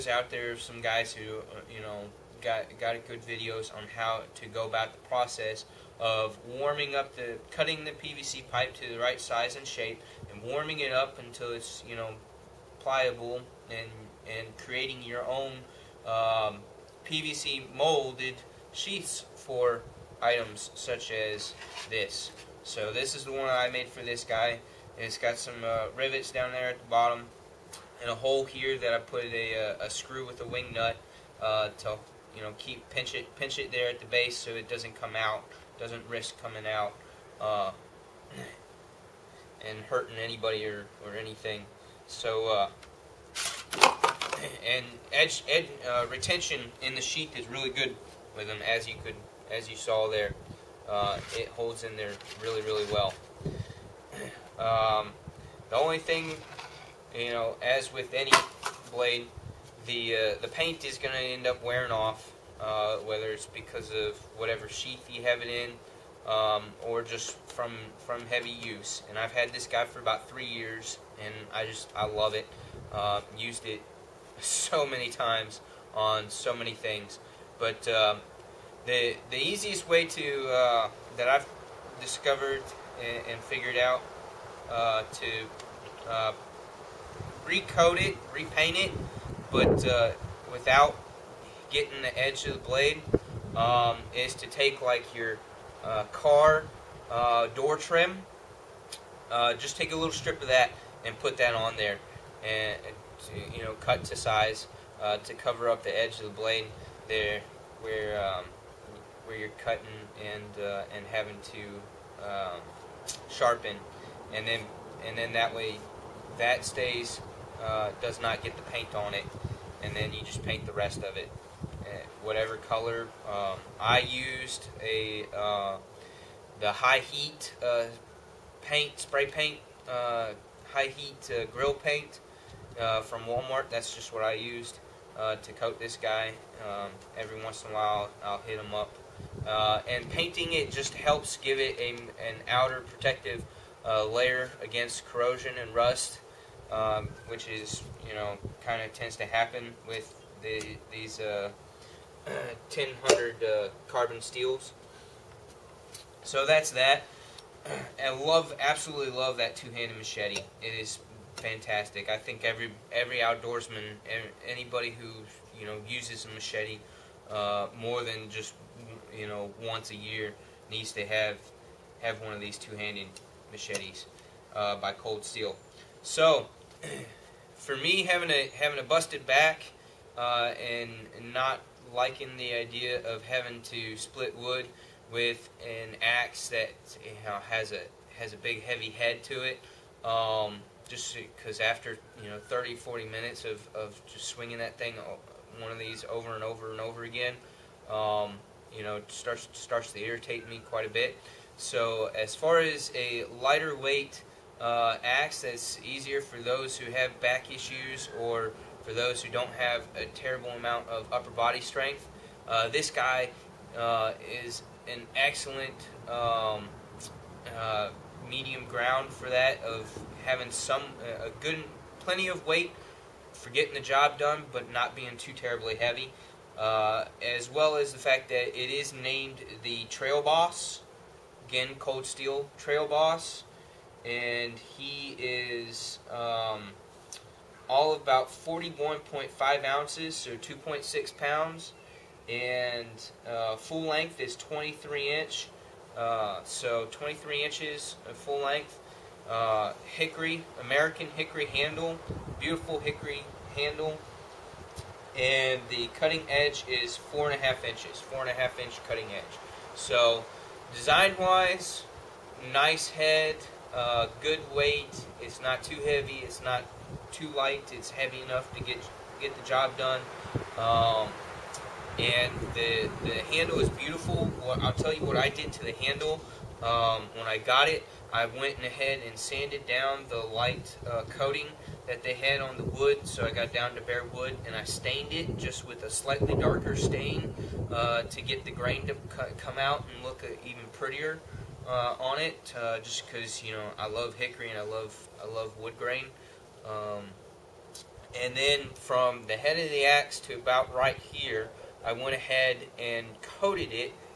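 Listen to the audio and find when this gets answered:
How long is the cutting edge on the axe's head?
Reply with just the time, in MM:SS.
04:16.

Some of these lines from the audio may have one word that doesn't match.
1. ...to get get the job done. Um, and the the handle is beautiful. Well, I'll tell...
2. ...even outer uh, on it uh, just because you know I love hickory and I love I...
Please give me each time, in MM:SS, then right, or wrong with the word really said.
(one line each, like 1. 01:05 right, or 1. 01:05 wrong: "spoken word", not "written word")
1. 04:28 right
2. 04:50 wrong: "prettier", not "outer".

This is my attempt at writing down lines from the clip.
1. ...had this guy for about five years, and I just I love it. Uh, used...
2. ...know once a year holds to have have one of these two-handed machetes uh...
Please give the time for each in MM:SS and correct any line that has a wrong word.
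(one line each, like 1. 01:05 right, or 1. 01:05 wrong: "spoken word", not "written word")
1. 01:09 wrong: "three", not "five"
2. 02:49 wrong: "needs", not "holds".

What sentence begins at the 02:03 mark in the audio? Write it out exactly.
Um, I used a uh, the high heat uh, paint, spray paint, uh, high heat uh, grill paint uh, from Walmart.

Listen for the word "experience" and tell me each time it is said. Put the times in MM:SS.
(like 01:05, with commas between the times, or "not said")
not said.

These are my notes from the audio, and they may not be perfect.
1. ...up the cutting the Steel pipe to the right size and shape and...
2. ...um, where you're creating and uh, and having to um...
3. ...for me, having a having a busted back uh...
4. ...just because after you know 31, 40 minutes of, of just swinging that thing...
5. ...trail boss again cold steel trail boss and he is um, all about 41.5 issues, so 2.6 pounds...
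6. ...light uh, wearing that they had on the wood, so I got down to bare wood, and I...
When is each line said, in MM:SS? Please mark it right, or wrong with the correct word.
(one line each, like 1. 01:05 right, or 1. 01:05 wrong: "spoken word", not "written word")
1. 00:06 wrong: "PVC", not "Steel"
2. 01:48 wrong: "cutting", not "creating"
3. 02:57 right
4. 03:10 wrong: "30", not "31"
5. 03:49 wrong: "ounces", not "issues"
6. 04:40 wrong: "coating", not "wearing".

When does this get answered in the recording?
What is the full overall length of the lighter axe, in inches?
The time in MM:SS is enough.
04:04.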